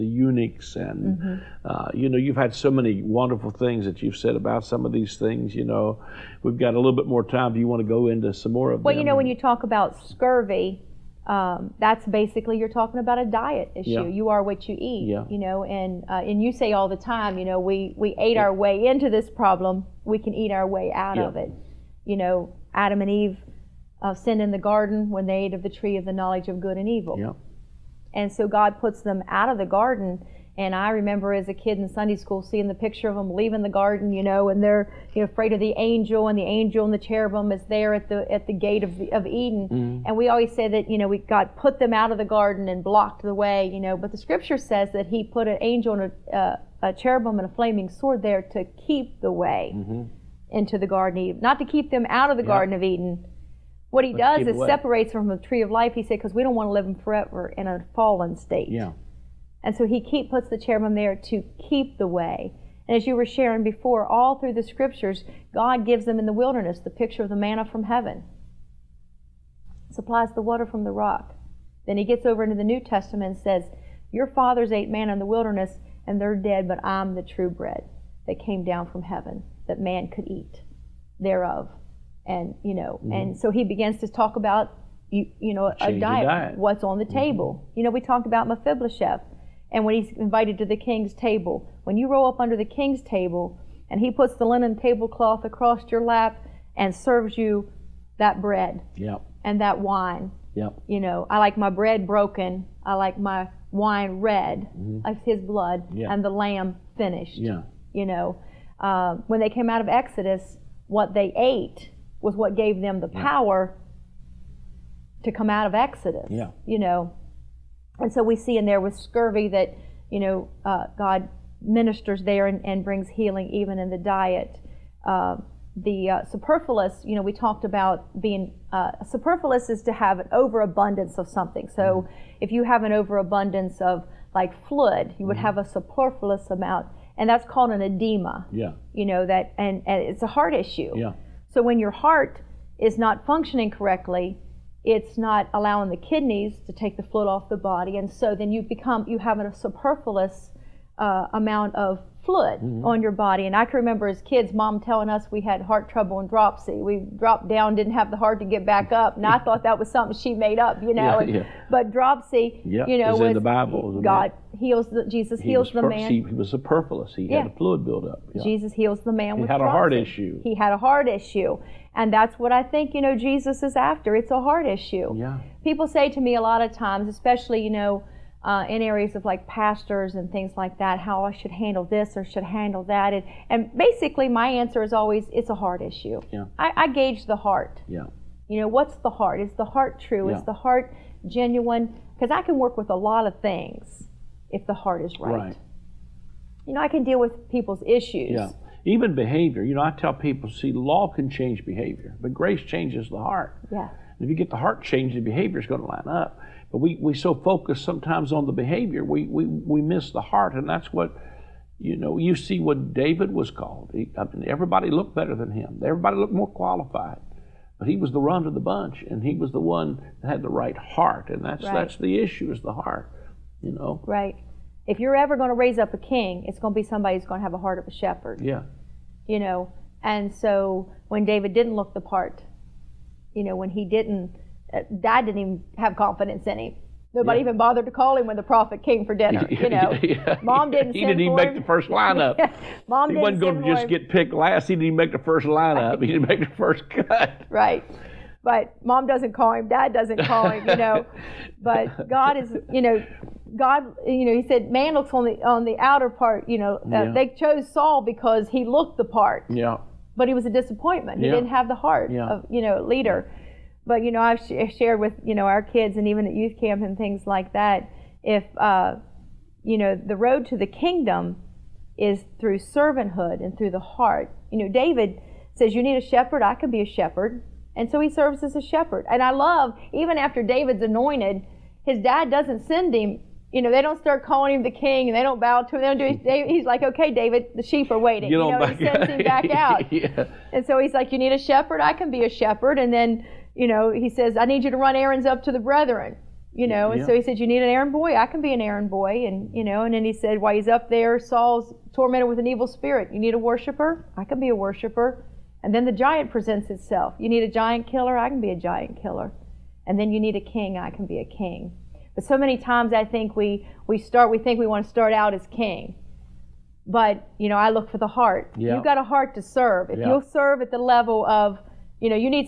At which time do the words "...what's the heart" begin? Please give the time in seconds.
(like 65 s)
188 s.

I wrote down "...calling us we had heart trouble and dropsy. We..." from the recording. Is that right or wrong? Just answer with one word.
wrong.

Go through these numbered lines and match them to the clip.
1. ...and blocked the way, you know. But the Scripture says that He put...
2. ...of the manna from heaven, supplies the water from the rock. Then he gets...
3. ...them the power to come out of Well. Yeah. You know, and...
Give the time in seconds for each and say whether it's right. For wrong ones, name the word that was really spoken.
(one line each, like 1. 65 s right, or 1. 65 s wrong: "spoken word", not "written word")
1. 42 s right
2. 67 s right
3. 112 s wrong: "Exodus", not "Well".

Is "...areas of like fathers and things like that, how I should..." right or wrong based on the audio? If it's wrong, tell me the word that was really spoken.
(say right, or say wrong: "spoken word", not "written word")
wrong: "pastors", not "fathers".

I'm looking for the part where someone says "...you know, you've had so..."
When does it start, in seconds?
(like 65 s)
1 s.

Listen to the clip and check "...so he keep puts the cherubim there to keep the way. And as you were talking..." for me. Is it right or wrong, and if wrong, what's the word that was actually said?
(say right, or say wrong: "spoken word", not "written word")
wrong: "sharing", not "talking".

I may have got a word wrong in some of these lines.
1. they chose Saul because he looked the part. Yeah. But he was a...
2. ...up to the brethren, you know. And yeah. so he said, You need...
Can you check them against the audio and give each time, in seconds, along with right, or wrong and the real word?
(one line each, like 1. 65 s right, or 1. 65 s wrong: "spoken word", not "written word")
1. 257 s right
2. 295 s right.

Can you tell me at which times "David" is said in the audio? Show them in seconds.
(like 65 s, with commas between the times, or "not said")
212 s, 231 s, 274 s, 280 s, 287 s.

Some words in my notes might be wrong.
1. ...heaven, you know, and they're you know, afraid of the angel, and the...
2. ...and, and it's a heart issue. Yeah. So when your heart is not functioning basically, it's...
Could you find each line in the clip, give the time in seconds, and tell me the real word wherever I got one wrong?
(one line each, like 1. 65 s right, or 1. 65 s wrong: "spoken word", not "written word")
1. 33 s wrong: "garden", not "heaven"
2. 139 s wrong: "correctly", not "basically".